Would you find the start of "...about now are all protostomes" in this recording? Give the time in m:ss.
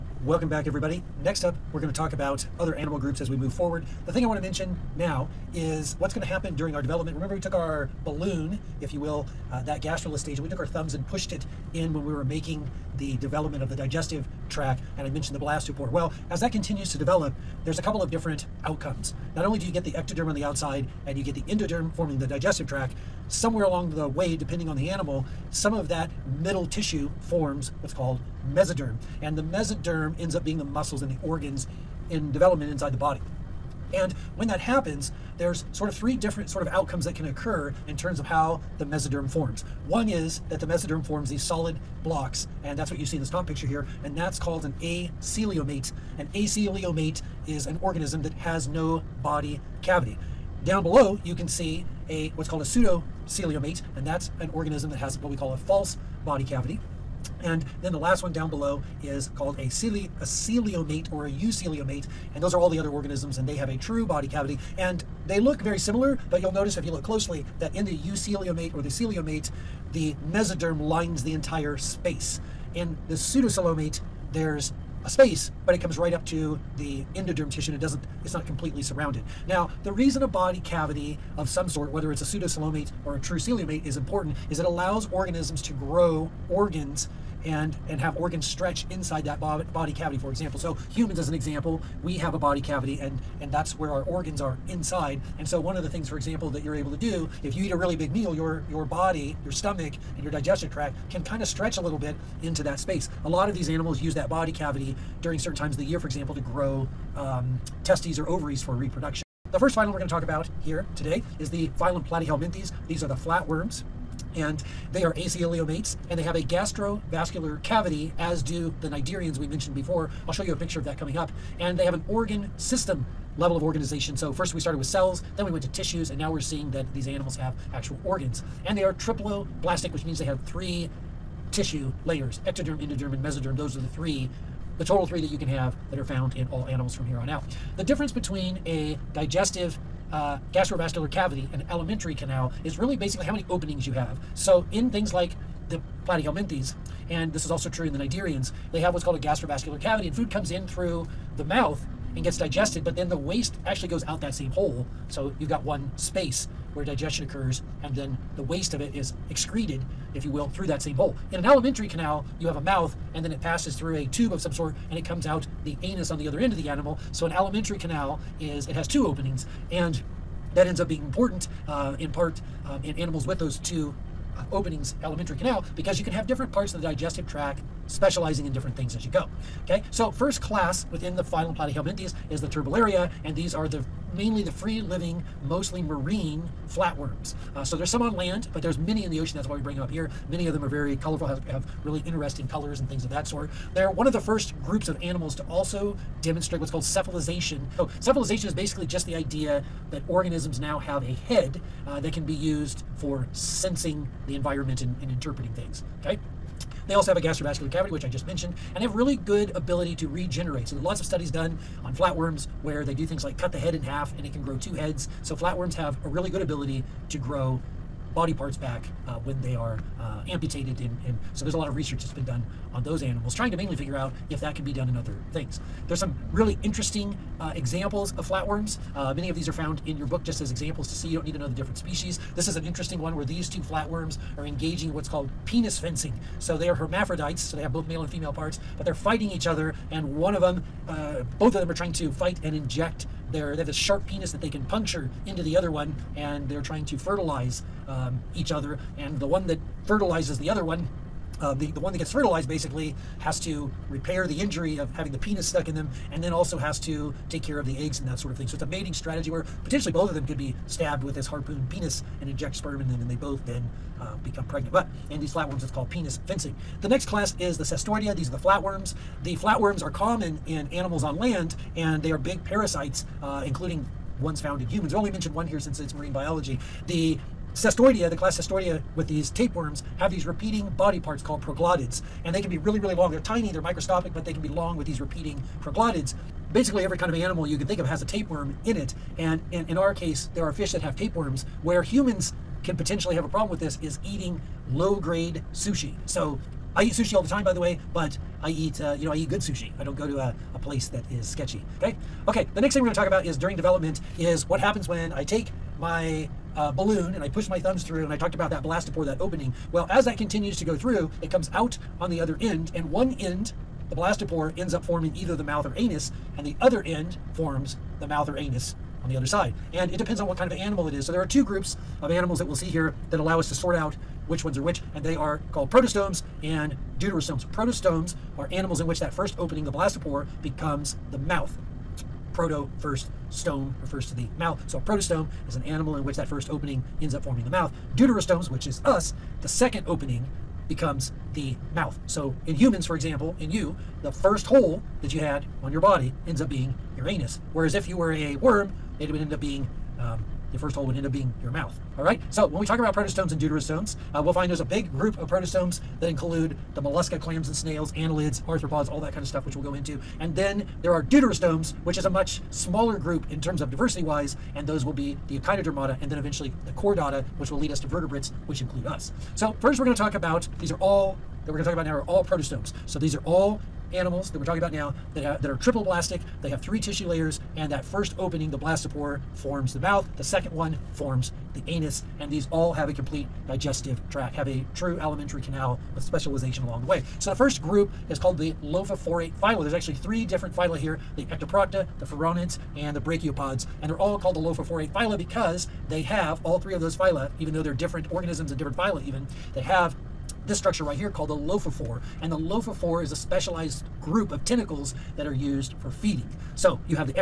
6:11.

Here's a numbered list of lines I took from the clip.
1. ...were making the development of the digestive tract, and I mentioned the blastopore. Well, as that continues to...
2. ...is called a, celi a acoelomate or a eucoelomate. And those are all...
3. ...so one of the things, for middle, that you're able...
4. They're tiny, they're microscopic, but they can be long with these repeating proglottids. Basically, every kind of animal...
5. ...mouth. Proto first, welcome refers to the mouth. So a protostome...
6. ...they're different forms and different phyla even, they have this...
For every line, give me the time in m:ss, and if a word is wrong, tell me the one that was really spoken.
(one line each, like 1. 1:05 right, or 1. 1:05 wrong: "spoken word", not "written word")
1. 0:12 right
2. 0:59 wrong: "coelomate", not "acoelomate"
3. 1:35 wrong: "example", not "middle"
4. 4:43 right
5. 5:31 wrong: "stome", not "welcome"
6. 6:37 wrong: "organisms", not "forms".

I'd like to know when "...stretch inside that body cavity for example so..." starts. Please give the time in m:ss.
1:28.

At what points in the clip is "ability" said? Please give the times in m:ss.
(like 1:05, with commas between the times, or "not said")
3:29, 3:36.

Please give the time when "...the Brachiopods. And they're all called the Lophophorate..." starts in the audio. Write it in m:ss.
6:32.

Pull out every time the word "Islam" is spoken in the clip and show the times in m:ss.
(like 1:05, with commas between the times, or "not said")
not said.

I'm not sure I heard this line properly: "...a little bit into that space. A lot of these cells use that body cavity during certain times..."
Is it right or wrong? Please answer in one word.
wrong.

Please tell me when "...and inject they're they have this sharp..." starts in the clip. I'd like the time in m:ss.
4:02.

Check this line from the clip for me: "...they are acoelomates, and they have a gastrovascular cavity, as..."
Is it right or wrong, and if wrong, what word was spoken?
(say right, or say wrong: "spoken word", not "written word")
right.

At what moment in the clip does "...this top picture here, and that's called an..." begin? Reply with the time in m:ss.
0:43.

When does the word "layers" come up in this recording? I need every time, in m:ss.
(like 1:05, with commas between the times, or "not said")
2:12, 6:17.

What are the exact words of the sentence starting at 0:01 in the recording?
Next up, we're going to talk about other animal groups as we move forward.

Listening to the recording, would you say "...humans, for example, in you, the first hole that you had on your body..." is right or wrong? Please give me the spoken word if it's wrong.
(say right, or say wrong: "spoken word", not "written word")
right.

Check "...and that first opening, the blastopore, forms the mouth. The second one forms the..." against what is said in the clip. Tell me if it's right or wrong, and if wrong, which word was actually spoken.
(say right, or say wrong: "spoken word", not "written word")
right.